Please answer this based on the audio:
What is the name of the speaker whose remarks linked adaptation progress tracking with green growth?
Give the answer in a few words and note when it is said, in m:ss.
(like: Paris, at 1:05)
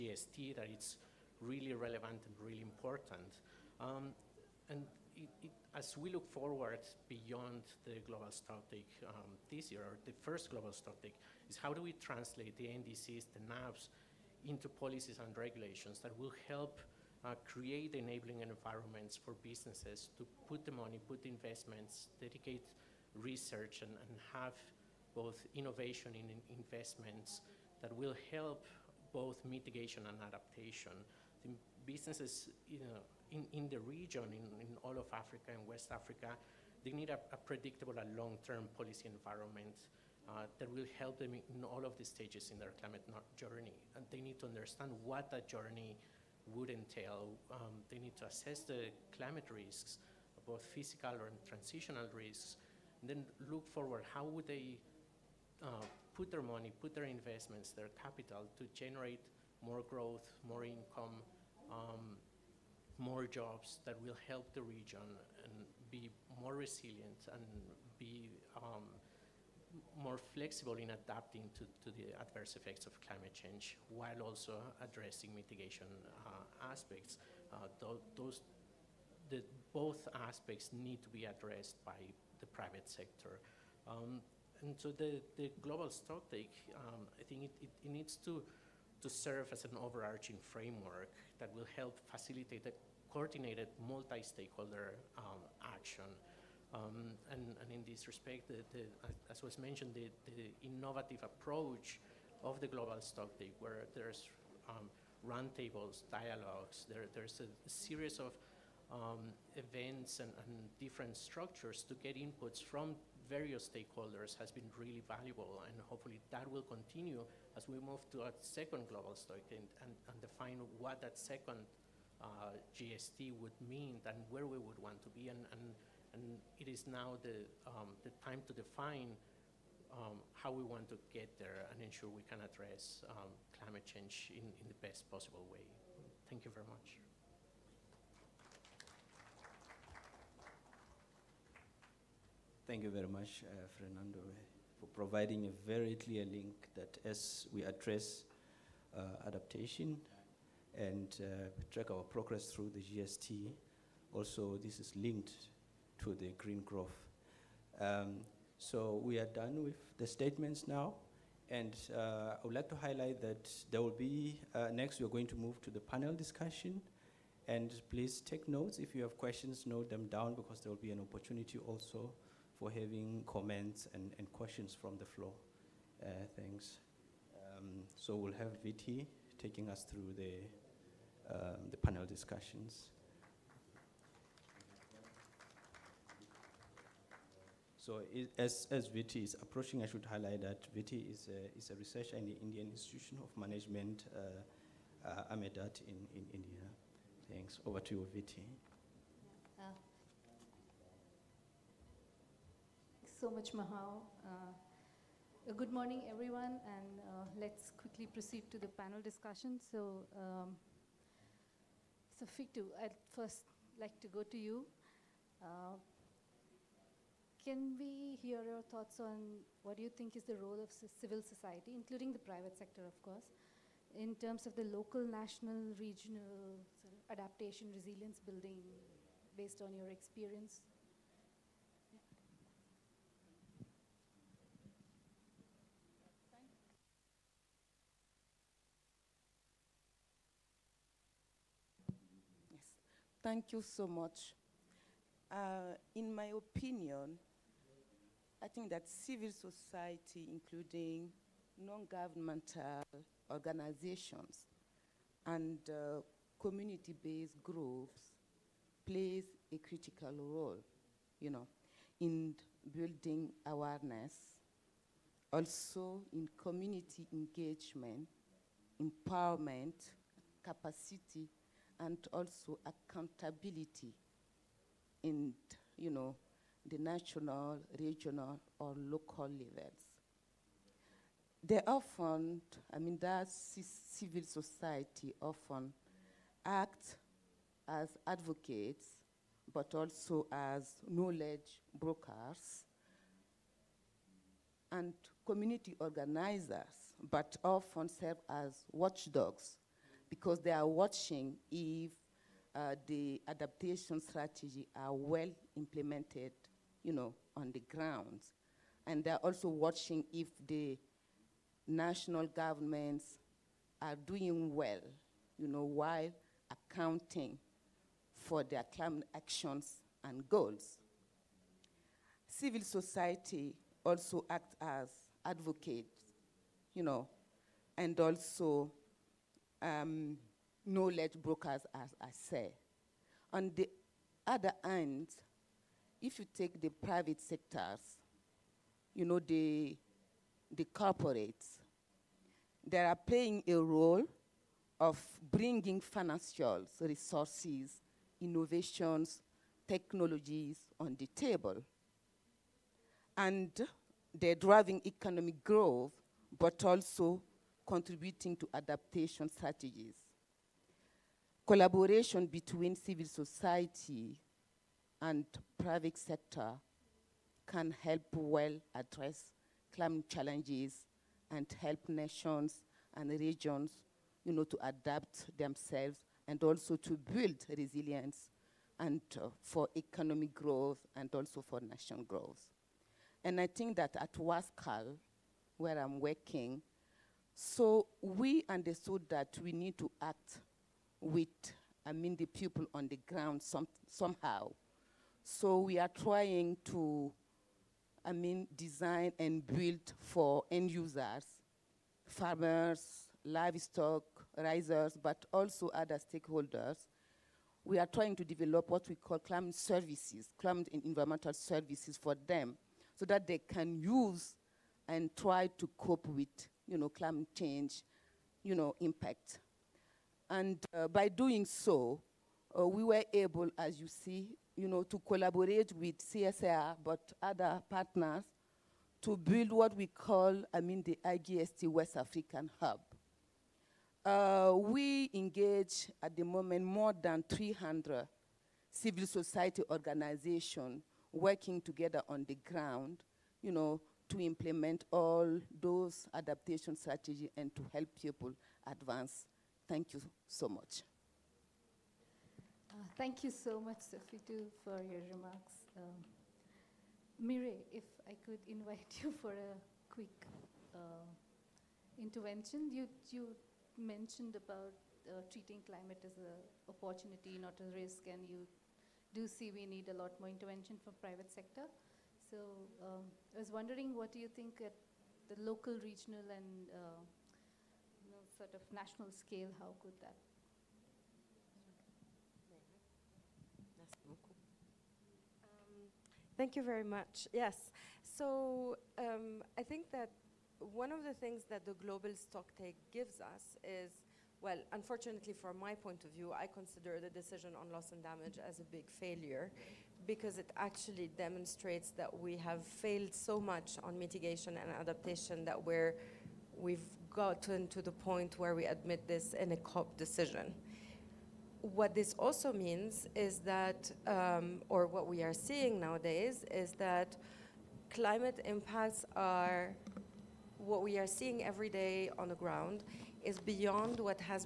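Fernando, at 2:23.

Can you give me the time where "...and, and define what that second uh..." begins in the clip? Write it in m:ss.
1:59.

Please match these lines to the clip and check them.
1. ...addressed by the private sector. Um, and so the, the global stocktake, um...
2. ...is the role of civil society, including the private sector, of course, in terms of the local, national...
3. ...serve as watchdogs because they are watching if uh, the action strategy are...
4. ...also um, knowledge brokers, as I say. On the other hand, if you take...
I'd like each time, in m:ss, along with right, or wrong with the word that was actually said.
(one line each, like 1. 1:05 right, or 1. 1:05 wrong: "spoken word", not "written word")
1. 1:21 right
2. 3:40 right
3. 4:57 wrong: "adaptation", not "action"
4. 5:27 right.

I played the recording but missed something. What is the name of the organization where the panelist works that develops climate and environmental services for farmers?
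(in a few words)
WASCAL.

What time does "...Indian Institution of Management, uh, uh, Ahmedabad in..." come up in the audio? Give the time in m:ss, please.
3:12.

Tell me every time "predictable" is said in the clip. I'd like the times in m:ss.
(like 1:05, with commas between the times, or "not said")
0:37.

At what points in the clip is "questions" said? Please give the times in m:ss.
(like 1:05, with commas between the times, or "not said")
2:49, 2:54.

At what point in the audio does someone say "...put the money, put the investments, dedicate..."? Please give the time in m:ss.
0:20.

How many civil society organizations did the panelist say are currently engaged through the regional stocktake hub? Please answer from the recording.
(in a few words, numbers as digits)
More than 300.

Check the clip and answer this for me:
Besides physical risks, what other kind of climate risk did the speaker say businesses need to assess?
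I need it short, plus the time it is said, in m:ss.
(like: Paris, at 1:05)
Transitional risks, at 0:51.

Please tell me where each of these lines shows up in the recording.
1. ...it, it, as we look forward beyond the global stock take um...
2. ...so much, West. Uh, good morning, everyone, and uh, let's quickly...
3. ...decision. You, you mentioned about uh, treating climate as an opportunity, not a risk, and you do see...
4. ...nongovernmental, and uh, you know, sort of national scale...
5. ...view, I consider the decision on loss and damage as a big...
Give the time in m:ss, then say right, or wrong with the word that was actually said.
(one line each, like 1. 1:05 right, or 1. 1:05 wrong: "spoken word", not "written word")
1. 0:05 right
2. 3:23 wrong: "Mahal", not "West"
3. 7:41 wrong: "intervention", not "decision"
4. 7:55 wrong: "regional", not "nongovernmental"
5. 8:16 right.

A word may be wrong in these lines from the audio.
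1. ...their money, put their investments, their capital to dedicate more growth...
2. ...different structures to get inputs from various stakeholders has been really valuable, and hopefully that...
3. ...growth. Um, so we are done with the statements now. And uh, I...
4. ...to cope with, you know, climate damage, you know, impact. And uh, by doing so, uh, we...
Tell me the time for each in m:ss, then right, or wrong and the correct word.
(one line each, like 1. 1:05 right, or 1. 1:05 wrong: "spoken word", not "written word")
1. 0:56 wrong: "generate", not "dedicate"
2. 1:50 right
3. 2:36 right
4. 6:55 wrong: "change", not "damage".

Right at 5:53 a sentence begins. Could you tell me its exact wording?
And they're driving economic growth, but also contributing to adaptation strategies.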